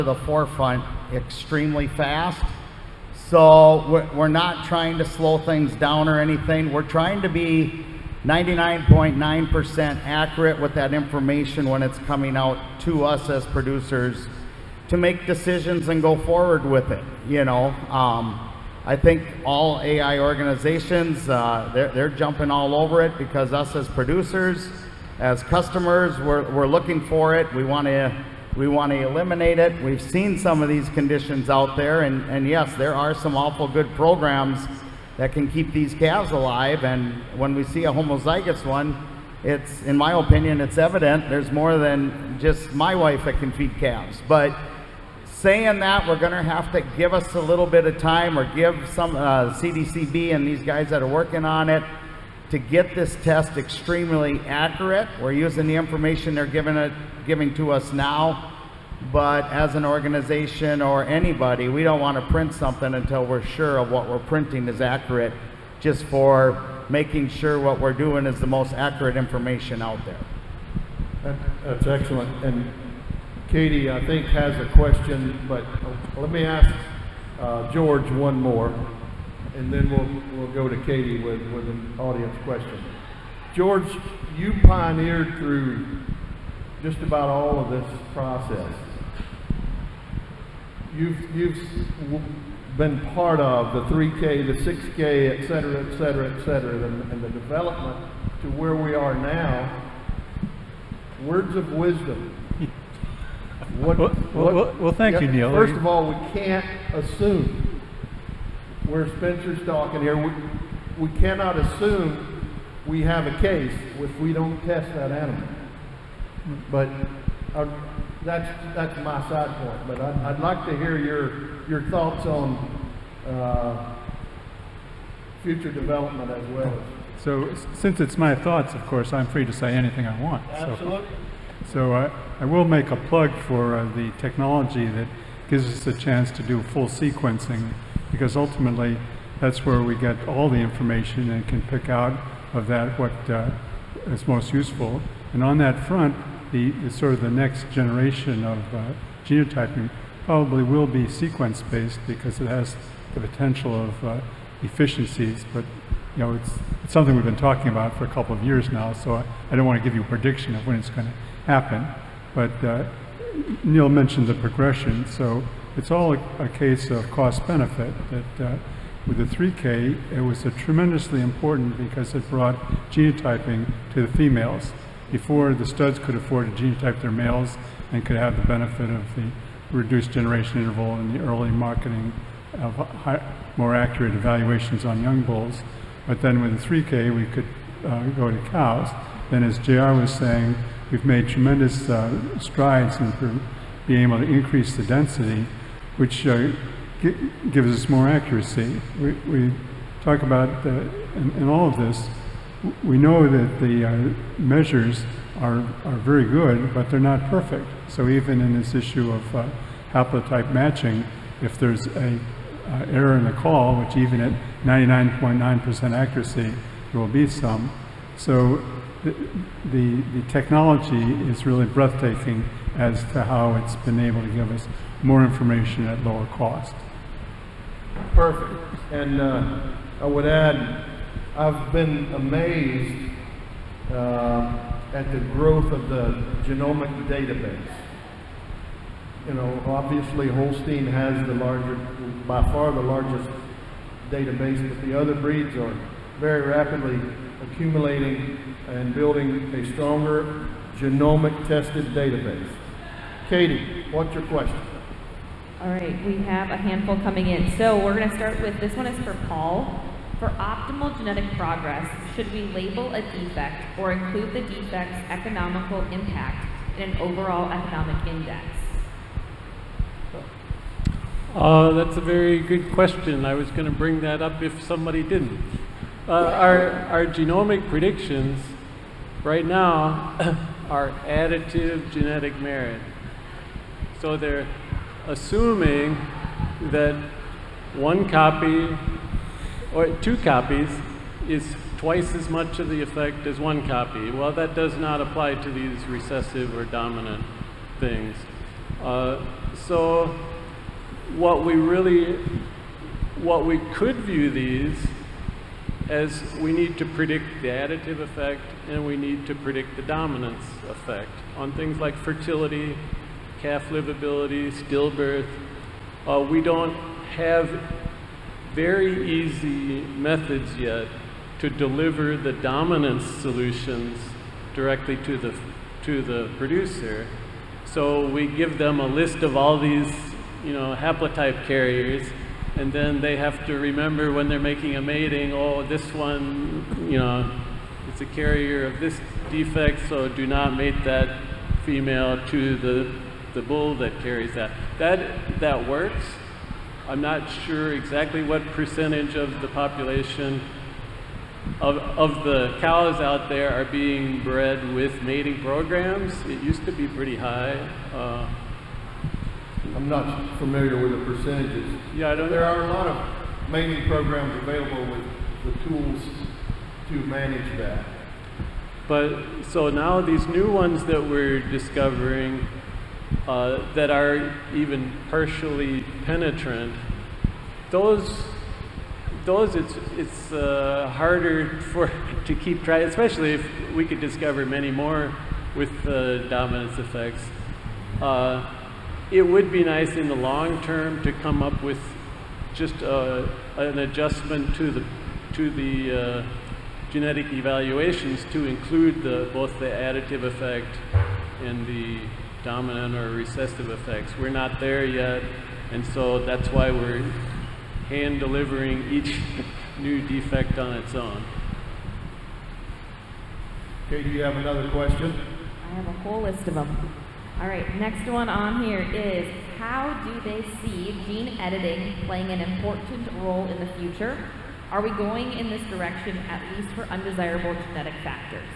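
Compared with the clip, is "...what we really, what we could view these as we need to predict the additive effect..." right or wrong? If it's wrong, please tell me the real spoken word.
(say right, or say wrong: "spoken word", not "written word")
right.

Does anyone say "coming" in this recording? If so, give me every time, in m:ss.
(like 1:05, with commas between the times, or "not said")
0:11, 4:17.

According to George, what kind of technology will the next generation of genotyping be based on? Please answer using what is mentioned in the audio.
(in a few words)
Sequence-based.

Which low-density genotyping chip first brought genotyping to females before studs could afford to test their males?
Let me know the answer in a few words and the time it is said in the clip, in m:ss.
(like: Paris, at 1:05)
3K, at 2:49.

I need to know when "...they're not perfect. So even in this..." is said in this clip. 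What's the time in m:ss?
3:26.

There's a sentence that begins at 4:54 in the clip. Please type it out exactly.
Well, that does not apply to these recessive or dominant things.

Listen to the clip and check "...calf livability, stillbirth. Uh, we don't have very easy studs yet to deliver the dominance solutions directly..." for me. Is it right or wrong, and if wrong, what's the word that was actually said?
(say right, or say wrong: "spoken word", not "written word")
wrong: "methods", not "studs".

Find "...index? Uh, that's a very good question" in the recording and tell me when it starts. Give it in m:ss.
4:28.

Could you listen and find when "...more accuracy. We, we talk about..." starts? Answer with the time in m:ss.
3:17.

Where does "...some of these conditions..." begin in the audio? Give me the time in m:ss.
0:30.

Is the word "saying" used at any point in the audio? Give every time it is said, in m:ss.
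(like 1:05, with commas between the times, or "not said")
0:45, 3:10.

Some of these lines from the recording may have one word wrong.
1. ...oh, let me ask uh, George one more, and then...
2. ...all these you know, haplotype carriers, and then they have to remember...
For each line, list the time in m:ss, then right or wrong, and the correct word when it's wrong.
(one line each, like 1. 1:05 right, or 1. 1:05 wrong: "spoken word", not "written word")
1. 1:16 right
2. 5:29 right.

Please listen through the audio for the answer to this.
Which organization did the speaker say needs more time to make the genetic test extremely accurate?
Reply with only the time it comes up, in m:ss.
0:49.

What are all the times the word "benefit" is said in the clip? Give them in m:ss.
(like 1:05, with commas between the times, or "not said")
2:47, 2:58.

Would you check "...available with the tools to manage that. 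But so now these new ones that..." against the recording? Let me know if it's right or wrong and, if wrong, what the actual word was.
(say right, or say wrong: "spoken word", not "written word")
right.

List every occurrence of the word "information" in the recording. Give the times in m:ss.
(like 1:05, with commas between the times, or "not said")
0:10, 0:55, 1:09, 2:20, 3:45.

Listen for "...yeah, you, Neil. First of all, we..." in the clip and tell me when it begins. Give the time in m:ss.
1:45.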